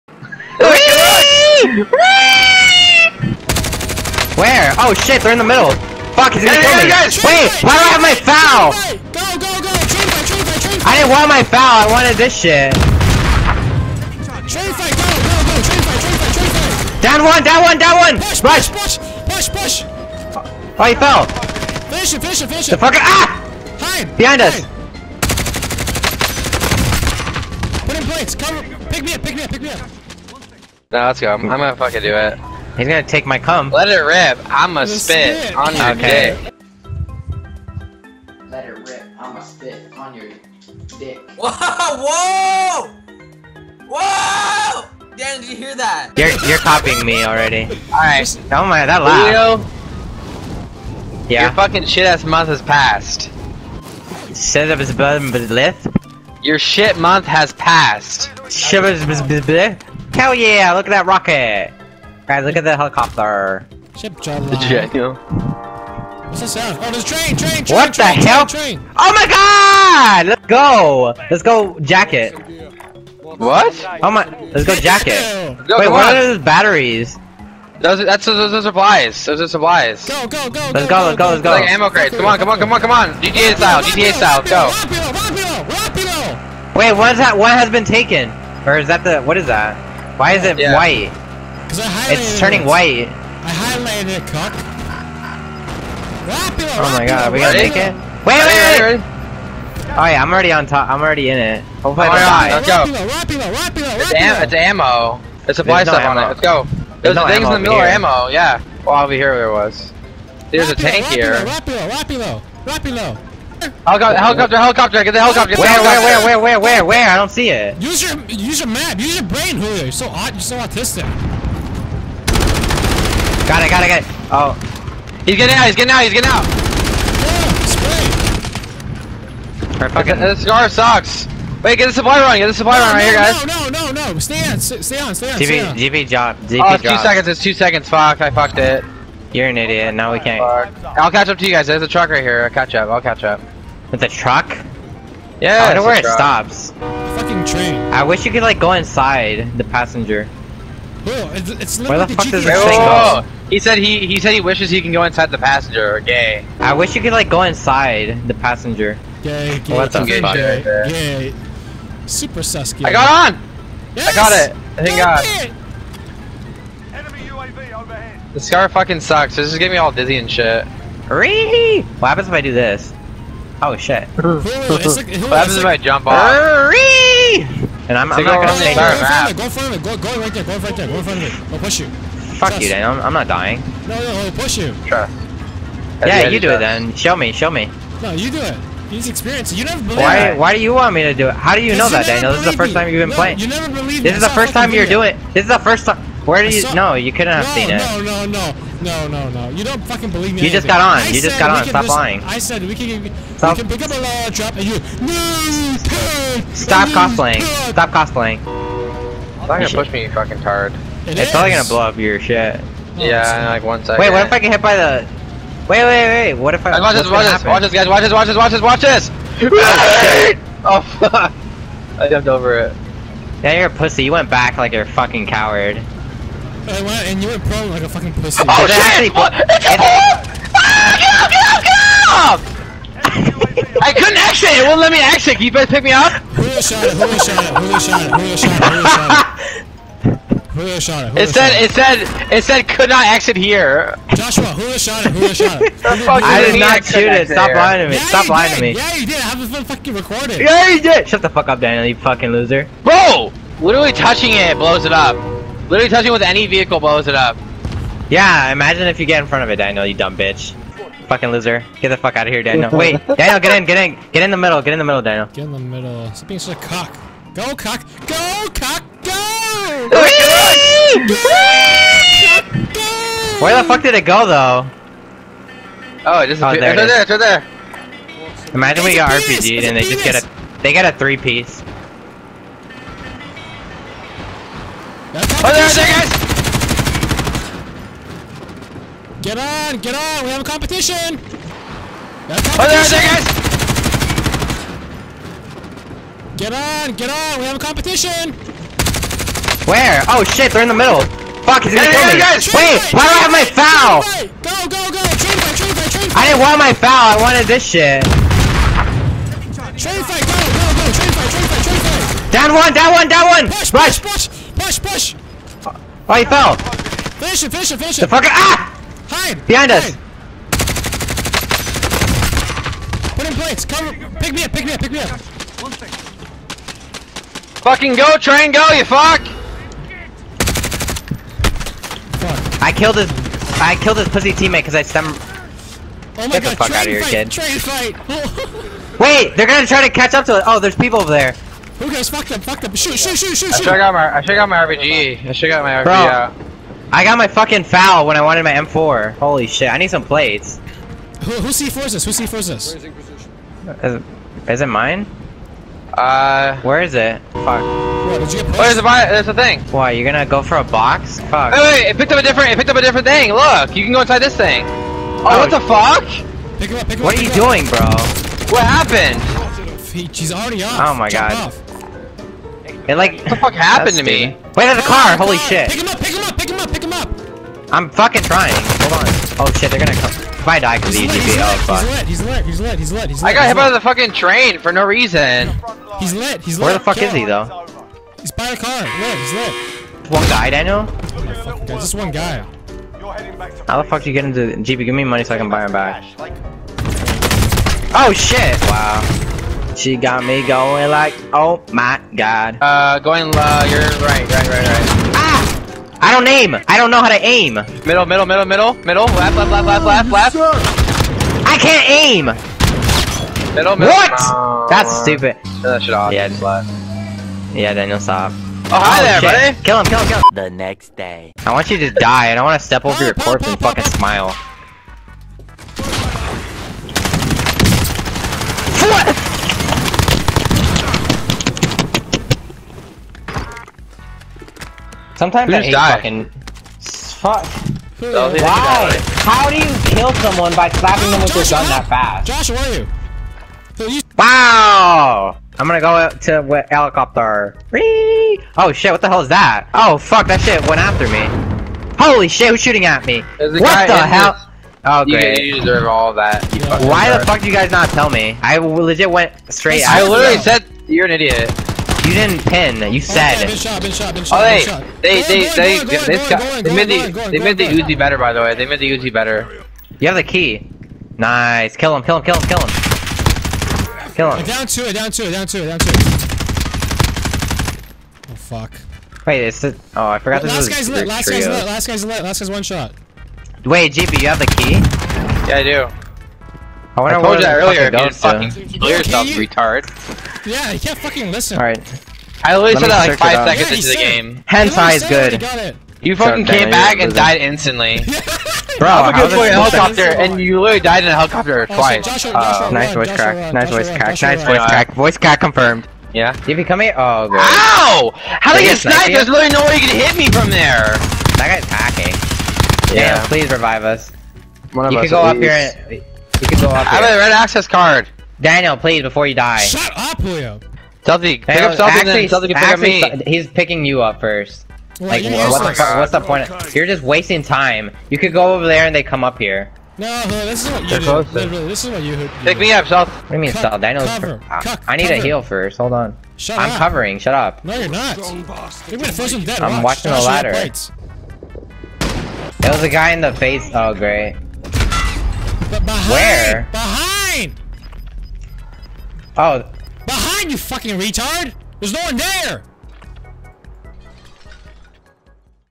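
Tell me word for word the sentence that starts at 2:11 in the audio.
Wait, get the supply run, get the supply no, run right no, here, guys.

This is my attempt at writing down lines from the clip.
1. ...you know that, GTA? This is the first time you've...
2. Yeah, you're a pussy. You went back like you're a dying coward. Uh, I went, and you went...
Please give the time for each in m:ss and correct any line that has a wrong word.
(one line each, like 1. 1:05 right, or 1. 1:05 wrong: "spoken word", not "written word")
1. 3:11 wrong: "Daniel", not "GTA"
2. 3:43 wrong: "fucking", not "dying".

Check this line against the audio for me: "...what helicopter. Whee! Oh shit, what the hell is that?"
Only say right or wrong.
right.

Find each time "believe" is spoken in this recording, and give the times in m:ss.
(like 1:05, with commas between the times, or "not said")
3:13, 3:20.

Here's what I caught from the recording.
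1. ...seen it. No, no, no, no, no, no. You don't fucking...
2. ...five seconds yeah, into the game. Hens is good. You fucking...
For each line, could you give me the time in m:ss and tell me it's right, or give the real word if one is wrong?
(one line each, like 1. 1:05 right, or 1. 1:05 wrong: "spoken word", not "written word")
1. 3:17 right
2. 8:13 right.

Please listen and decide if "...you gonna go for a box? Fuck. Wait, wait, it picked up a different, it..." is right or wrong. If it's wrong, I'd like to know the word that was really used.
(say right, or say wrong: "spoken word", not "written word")
right.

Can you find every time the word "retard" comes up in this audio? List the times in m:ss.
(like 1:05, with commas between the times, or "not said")
8:09, 9:10.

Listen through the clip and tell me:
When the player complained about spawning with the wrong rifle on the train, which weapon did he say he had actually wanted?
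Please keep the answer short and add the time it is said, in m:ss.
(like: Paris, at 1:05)
M4, at 5:48.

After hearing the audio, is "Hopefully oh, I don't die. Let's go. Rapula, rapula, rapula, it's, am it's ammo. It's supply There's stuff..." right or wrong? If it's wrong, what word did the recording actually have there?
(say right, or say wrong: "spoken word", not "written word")
right.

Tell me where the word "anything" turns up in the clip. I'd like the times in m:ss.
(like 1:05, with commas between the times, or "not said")
3:20.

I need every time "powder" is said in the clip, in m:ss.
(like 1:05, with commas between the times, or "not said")
not said.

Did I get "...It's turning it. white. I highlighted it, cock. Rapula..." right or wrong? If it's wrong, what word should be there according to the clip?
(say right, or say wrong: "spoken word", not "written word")
right.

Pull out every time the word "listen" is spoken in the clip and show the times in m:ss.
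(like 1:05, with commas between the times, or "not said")
3:21, 8:11.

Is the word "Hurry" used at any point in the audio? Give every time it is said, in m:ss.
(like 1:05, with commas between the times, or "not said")
2:51, 2:56.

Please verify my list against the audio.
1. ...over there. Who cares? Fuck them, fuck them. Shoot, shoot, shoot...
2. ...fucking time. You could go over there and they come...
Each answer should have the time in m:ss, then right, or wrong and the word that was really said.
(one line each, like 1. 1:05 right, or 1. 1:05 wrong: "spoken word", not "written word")
1. 5:41 right
2. 8:47 wrong: "wasting", not "fucking".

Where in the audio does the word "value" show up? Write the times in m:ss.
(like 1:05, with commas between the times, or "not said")
not said.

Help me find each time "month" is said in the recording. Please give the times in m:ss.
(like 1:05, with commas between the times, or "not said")
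0:52, 0:56.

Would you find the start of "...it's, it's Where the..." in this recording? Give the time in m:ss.
2:31.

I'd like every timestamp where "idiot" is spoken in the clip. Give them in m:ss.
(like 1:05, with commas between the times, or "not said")
2:19, 7:41.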